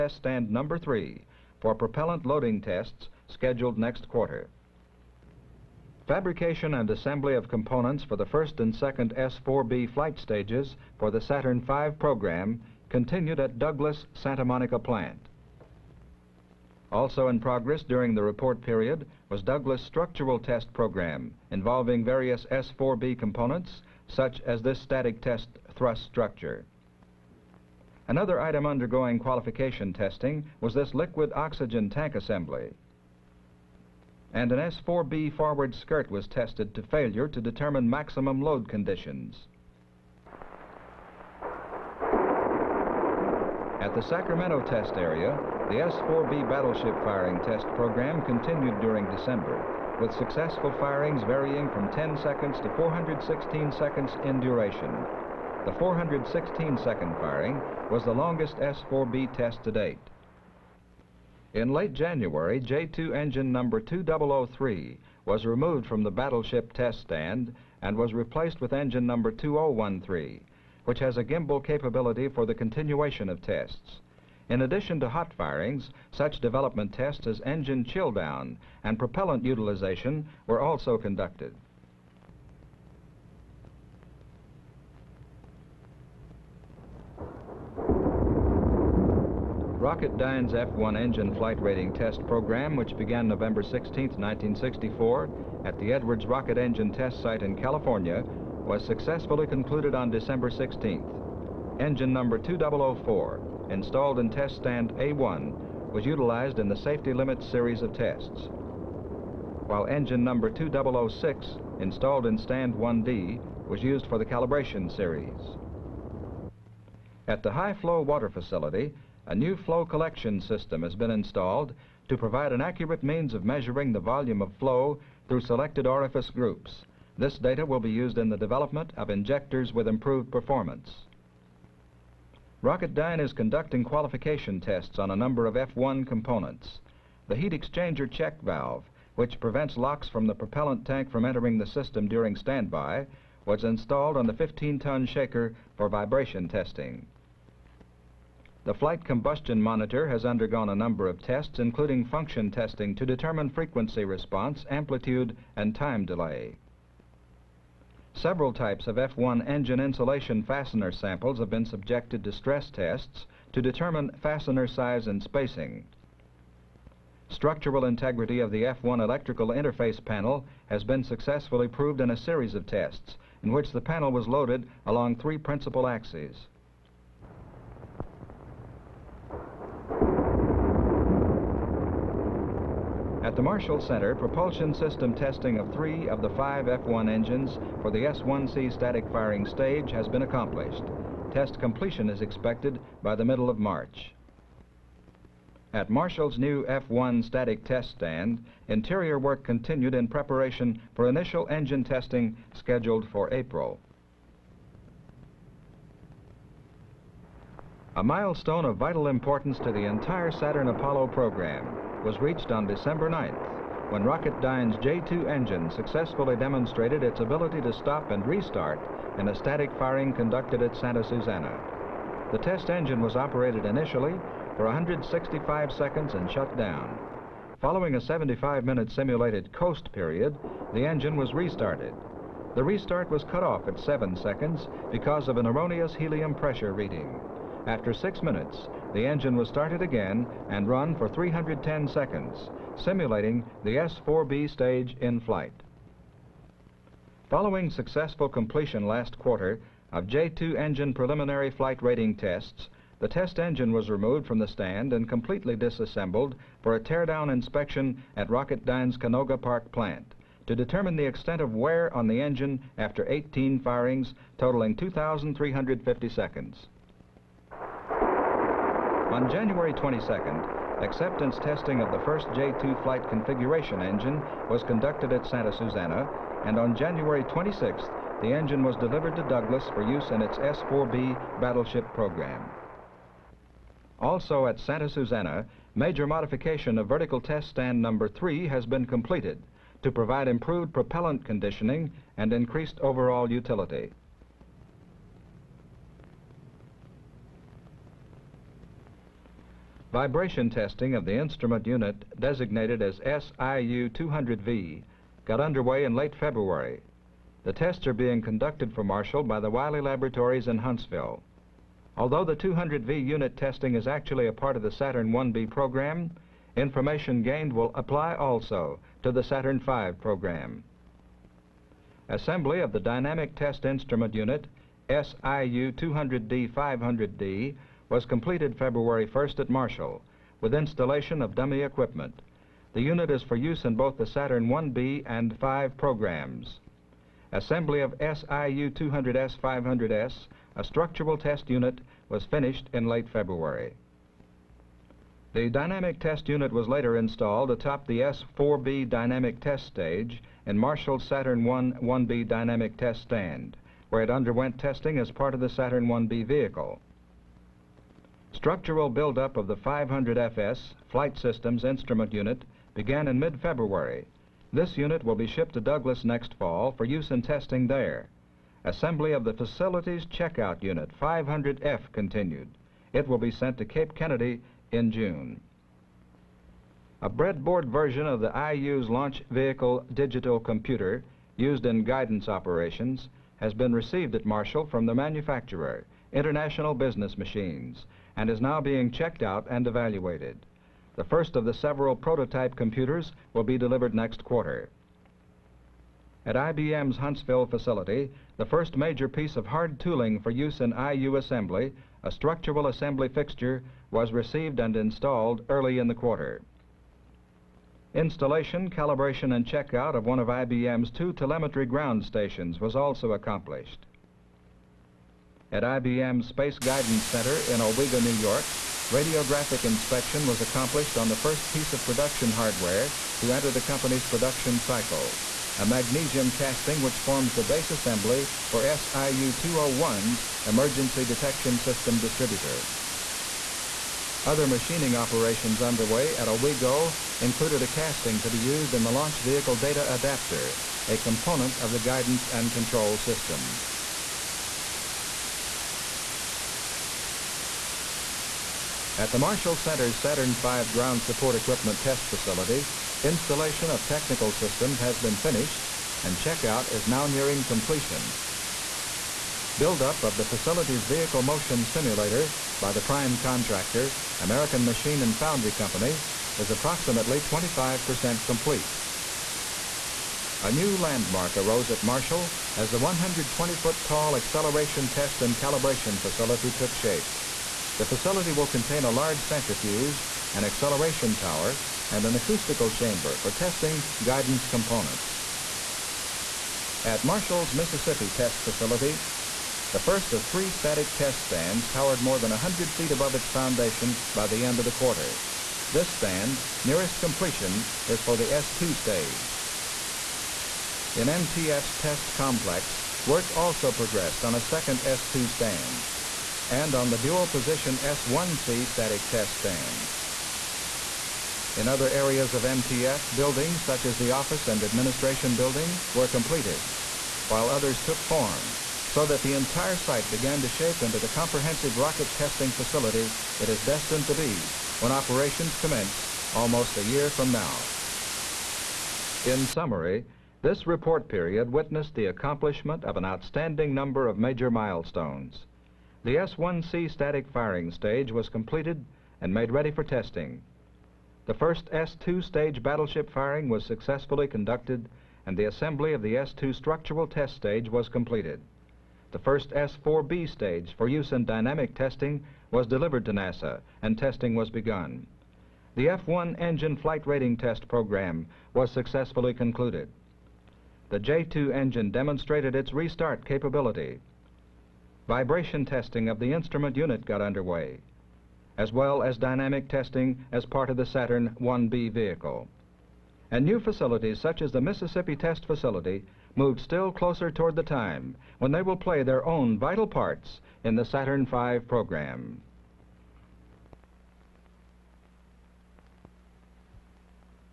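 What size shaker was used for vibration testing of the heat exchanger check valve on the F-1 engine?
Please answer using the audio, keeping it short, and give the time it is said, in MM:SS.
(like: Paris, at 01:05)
15-ton, at 02:24.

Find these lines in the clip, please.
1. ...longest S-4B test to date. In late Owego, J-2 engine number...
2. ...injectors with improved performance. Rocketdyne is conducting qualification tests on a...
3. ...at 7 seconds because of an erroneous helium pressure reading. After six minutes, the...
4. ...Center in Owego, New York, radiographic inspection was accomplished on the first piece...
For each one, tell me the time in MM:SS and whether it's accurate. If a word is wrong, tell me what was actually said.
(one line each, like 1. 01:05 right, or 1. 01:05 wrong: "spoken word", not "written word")
1. 00:58 wrong: "January", not "Owego"
2. 02:09 right
3. 03:53 right
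4. 06:57 right.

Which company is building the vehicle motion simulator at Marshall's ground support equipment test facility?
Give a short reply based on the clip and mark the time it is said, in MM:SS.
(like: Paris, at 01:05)
American Machine and Foundry, at 07:44.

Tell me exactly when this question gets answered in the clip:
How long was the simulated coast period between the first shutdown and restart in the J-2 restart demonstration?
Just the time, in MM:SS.
03:47.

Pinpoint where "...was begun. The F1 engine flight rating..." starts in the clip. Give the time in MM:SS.
09:14.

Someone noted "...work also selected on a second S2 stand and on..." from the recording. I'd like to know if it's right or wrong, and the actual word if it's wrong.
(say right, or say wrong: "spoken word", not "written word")
wrong: "progressed", not "selected".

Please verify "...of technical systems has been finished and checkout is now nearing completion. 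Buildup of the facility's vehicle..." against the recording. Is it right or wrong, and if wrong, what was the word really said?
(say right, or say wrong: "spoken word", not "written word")
right.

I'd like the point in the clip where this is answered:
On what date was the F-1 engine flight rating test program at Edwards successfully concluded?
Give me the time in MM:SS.
01:40.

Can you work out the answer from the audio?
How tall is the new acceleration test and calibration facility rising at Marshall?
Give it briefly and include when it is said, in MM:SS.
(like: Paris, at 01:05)
120 feet, at 07:52.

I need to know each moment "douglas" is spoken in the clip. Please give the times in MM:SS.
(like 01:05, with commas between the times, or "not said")
00:13, 00:19, 04:39, 06:05.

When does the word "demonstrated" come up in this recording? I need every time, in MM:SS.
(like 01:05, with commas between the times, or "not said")
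03:36, 09:21.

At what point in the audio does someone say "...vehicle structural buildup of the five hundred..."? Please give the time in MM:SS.
05:56.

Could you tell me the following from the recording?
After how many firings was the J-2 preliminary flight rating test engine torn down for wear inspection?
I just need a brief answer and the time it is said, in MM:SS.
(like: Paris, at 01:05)
18, at 04:23.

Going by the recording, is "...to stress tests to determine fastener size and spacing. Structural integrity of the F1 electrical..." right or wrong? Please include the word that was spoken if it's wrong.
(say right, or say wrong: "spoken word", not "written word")
right.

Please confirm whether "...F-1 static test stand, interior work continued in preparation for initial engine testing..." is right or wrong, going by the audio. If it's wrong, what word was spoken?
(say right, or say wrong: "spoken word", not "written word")
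right.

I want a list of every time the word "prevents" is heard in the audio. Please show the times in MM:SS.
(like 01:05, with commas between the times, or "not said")
02:19.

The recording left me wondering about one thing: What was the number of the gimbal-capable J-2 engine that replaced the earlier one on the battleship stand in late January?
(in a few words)
2013.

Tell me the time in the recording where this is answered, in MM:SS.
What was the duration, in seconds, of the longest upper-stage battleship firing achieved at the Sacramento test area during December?
00:52.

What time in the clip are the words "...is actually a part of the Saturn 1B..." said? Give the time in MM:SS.
05:13.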